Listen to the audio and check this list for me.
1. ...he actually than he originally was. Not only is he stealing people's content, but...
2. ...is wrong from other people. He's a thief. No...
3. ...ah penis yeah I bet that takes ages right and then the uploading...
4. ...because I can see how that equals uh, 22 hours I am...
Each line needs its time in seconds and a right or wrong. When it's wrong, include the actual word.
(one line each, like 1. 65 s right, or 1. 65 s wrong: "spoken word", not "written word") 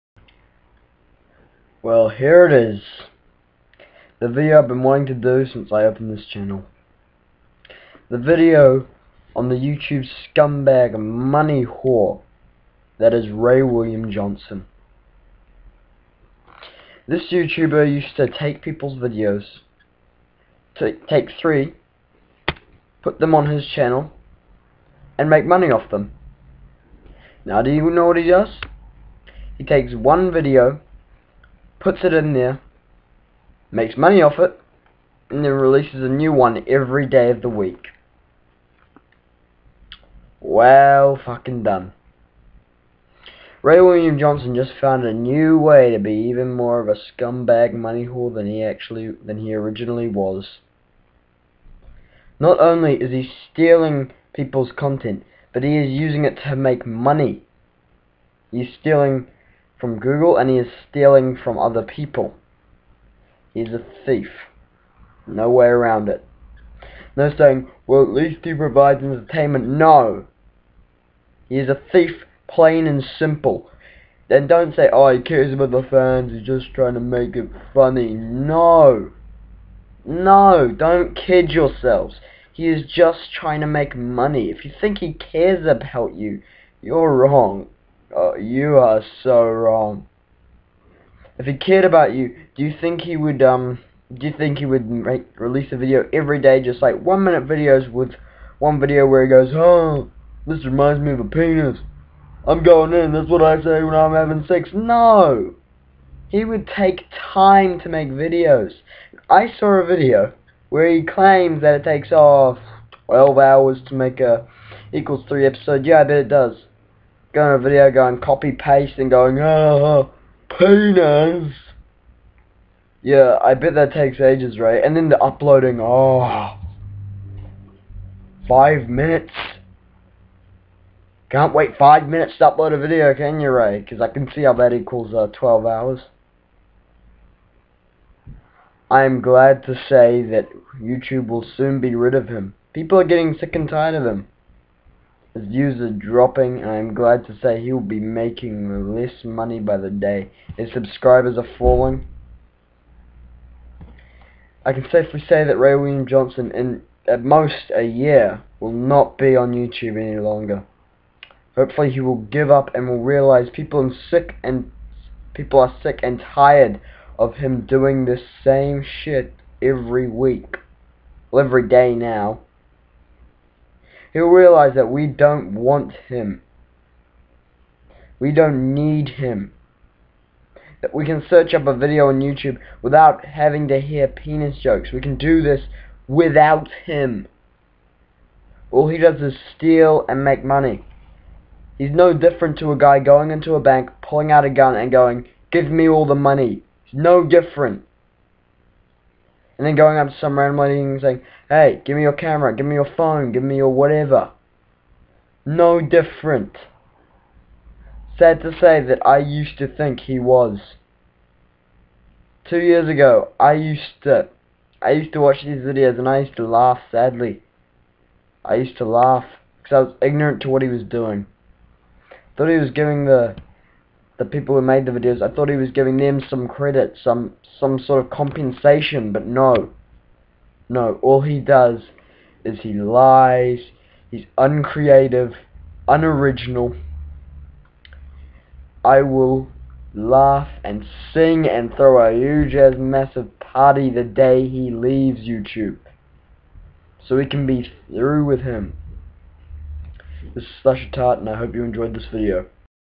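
1. 48 s right
2. 60 s wrong: "stealing", not "wrong"
3. 119 s right
4. 133 s wrong: "12", not "22".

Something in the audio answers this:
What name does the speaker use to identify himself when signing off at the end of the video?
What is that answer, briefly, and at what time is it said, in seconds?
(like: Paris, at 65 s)
Slashertart, at 250 s.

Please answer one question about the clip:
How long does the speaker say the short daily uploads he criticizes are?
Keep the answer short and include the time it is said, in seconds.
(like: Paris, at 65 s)
one minute, at 97 s.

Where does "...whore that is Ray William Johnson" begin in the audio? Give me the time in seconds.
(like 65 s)
11 s.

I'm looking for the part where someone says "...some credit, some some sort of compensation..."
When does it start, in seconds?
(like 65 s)
226 s.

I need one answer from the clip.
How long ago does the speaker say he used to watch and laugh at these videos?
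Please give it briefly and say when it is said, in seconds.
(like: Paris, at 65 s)
2 years, at 212 s.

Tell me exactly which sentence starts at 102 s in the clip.
I'm going in, that's what I say when I'm having sex.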